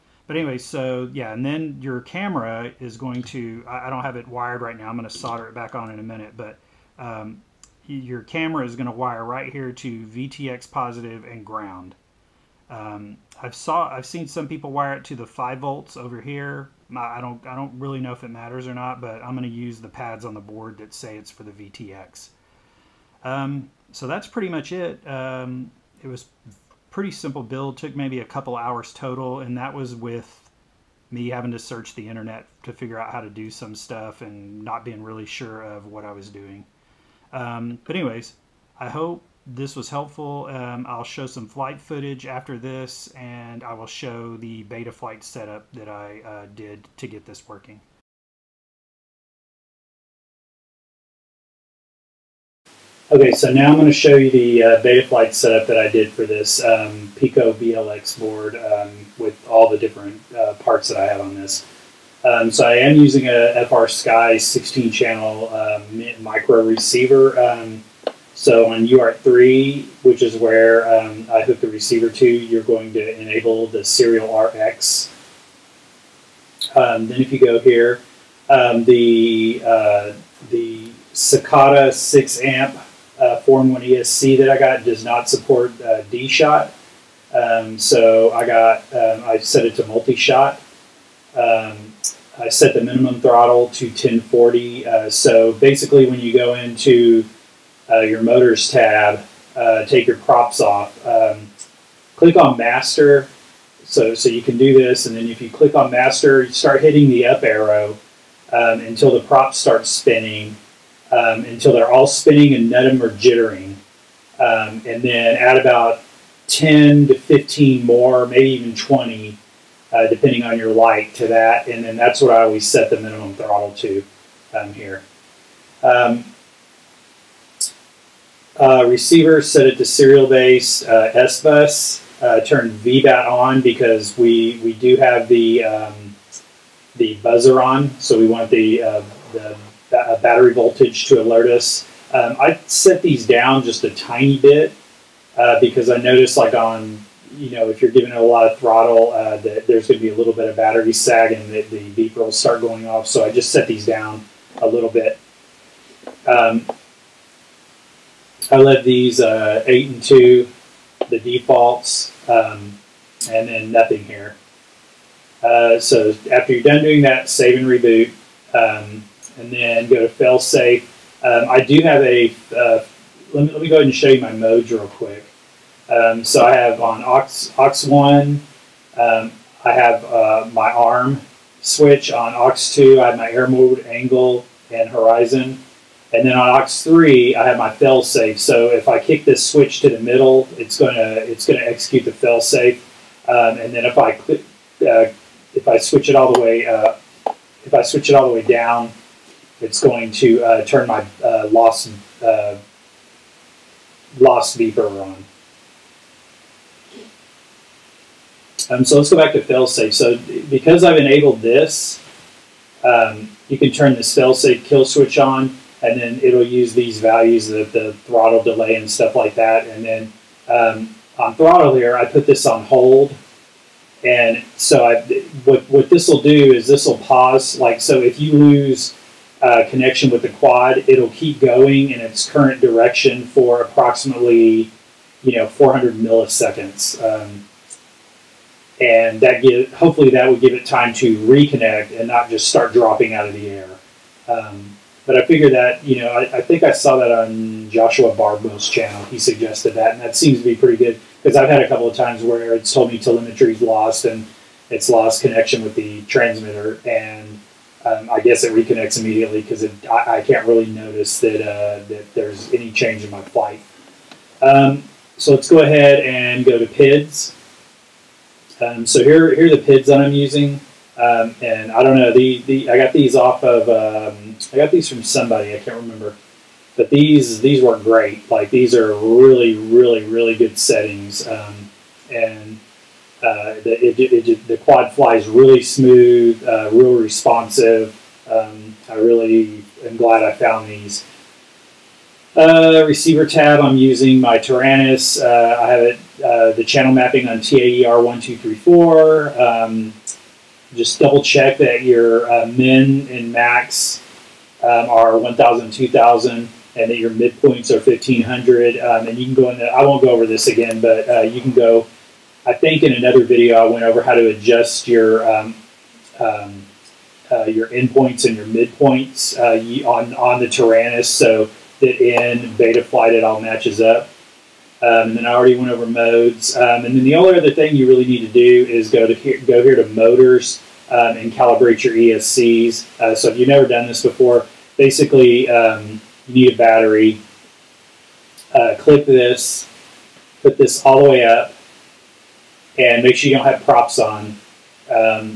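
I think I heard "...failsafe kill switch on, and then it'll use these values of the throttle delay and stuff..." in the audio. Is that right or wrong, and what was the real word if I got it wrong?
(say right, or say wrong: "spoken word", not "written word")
right.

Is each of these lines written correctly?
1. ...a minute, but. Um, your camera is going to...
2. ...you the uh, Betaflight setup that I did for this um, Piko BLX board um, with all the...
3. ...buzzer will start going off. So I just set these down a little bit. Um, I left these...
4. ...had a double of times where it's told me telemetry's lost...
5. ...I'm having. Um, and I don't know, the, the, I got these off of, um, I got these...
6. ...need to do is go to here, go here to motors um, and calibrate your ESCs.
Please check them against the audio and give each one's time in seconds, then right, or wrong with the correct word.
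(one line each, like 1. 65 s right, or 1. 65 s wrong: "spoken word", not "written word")
1. 5 s right
2. 54 s right
3. 151 s wrong: "beeper", not "buzzer"
4. 251 s wrong: "couple", not "double"
5. 270 s wrong: "using", not "having"
6. 328 s right.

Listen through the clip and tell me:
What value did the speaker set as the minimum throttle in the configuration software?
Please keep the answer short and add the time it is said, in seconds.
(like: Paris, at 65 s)
1040, at 93 s.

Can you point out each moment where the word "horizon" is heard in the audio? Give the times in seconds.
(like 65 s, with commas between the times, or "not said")
184 s.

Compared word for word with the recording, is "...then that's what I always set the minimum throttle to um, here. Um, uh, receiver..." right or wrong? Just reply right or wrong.
right.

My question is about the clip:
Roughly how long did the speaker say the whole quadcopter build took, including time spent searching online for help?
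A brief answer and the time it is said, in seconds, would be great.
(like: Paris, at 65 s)
a couple hours, at 28 s.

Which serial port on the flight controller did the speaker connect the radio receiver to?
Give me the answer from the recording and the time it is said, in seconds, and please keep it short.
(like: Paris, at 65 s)
UART3, at 68 s.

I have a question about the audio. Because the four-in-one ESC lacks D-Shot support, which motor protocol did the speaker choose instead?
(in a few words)
Multi-shot.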